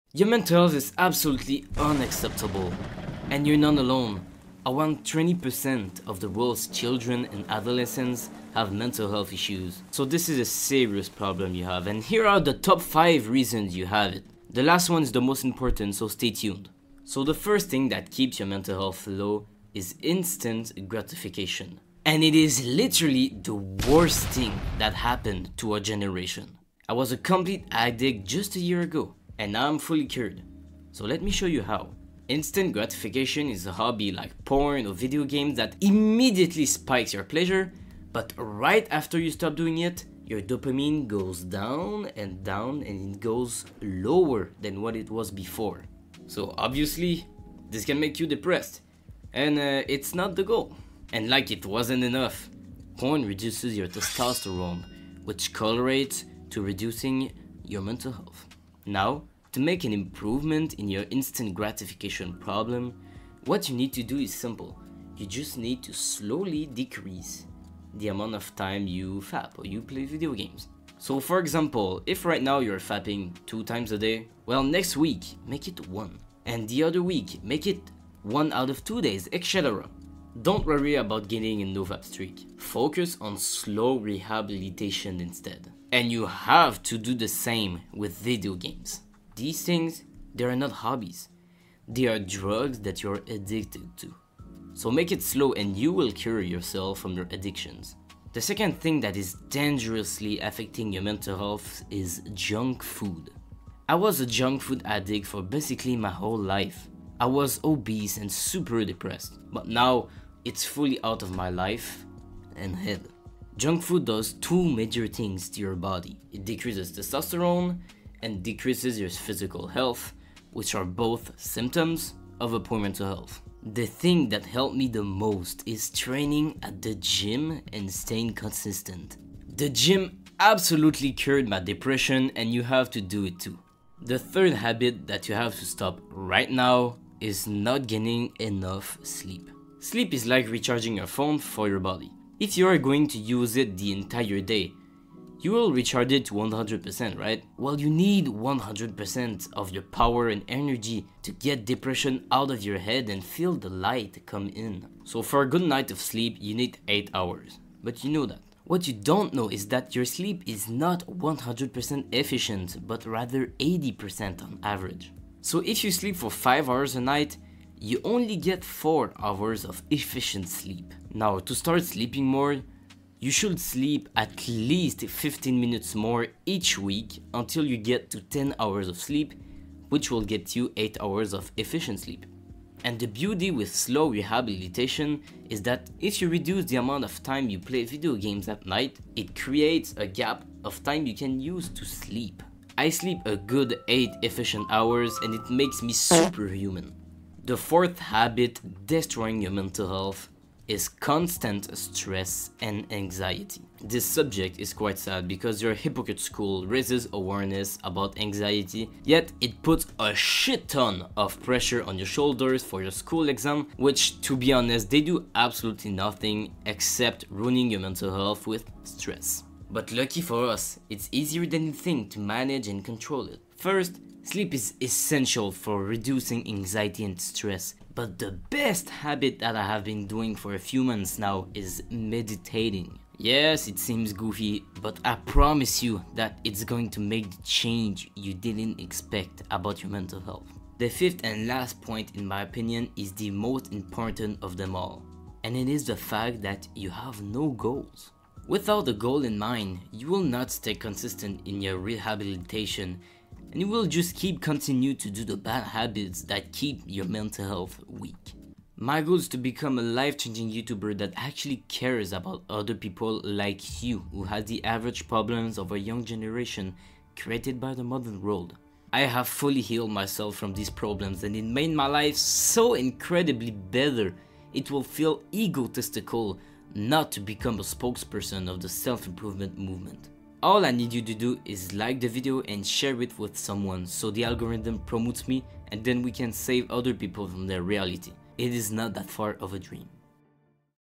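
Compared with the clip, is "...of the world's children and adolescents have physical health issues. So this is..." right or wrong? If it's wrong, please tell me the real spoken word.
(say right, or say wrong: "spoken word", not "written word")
wrong: "mental", not "physical".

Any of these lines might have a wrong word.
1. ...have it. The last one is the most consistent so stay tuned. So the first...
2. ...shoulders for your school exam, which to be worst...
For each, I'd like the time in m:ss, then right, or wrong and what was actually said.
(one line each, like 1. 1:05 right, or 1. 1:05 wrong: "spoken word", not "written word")
1. 0:13 wrong: "important", not "consistent"
2. 3:32 wrong: "honest", not "worst".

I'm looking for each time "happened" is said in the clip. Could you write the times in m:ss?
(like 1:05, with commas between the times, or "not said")
0:24.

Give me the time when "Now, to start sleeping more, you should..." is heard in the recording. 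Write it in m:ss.
2:51.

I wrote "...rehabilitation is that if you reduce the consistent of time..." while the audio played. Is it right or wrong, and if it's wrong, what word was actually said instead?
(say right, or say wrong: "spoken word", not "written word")
wrong: "amount", not "consistent".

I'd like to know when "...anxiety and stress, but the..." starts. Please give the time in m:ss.
3:46.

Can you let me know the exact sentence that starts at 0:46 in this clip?
So obviously, this can make you depressed, and uh, it's not the goal.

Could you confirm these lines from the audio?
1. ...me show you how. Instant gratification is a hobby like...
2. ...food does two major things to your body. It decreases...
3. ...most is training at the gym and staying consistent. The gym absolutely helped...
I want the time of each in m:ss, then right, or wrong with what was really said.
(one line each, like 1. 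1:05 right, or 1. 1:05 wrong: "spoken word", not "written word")
1. 0:31 right
2. 1:53 right
3. 2:05 wrong: "cured", not "helped".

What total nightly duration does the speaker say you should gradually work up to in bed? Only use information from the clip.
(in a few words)
10 hours.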